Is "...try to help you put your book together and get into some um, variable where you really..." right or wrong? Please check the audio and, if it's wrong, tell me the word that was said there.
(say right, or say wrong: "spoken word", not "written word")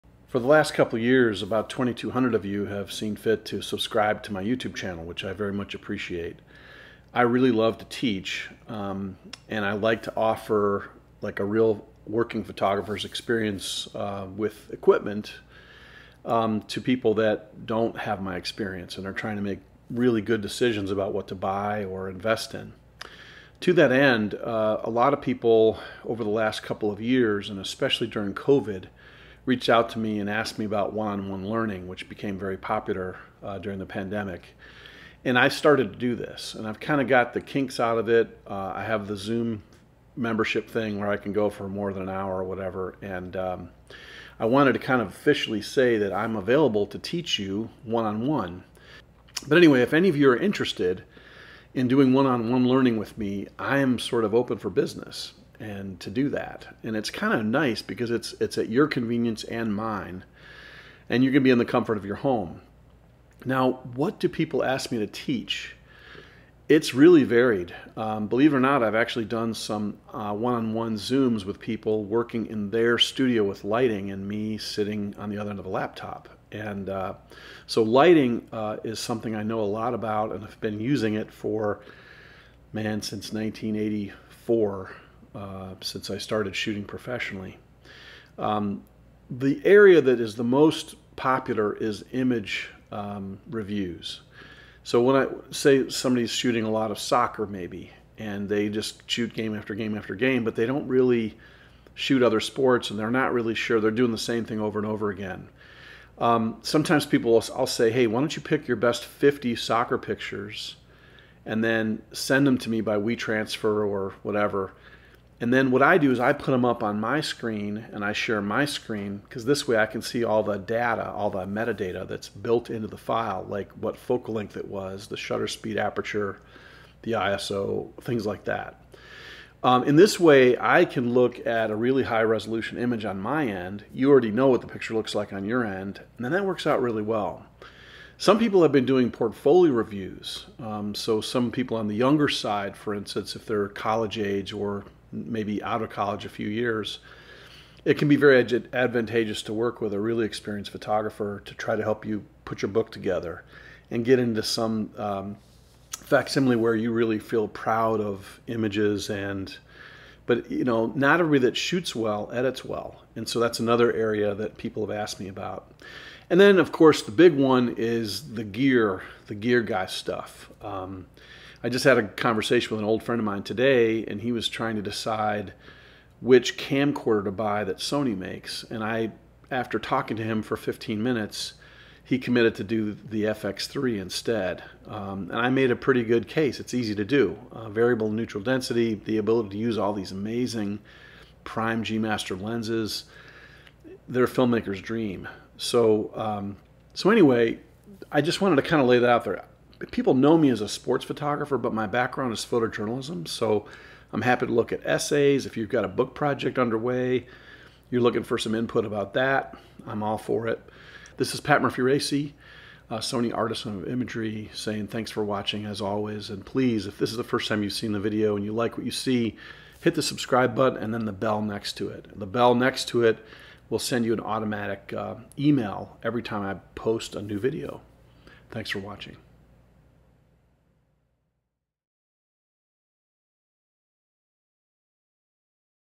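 wrong: "facsimile", not "variable".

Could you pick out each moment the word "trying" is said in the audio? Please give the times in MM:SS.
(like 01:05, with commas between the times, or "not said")
00:19, 02:54.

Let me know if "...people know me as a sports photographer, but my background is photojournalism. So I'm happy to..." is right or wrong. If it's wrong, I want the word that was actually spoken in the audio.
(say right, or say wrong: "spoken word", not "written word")
right.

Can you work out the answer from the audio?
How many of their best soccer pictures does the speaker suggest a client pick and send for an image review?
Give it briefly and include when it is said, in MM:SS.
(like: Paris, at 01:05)
50, at 01:49.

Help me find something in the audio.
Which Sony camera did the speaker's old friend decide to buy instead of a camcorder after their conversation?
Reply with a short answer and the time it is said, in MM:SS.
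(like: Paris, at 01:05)
FX3, at 03:03.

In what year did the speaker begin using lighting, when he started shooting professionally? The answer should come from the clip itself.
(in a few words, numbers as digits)
1984.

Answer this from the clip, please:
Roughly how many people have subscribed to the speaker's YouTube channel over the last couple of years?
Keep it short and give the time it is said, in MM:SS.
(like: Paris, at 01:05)
2,200, at 00:01.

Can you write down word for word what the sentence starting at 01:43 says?
They're doing the same thing over and over again.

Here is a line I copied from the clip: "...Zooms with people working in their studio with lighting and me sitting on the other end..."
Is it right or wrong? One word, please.
right.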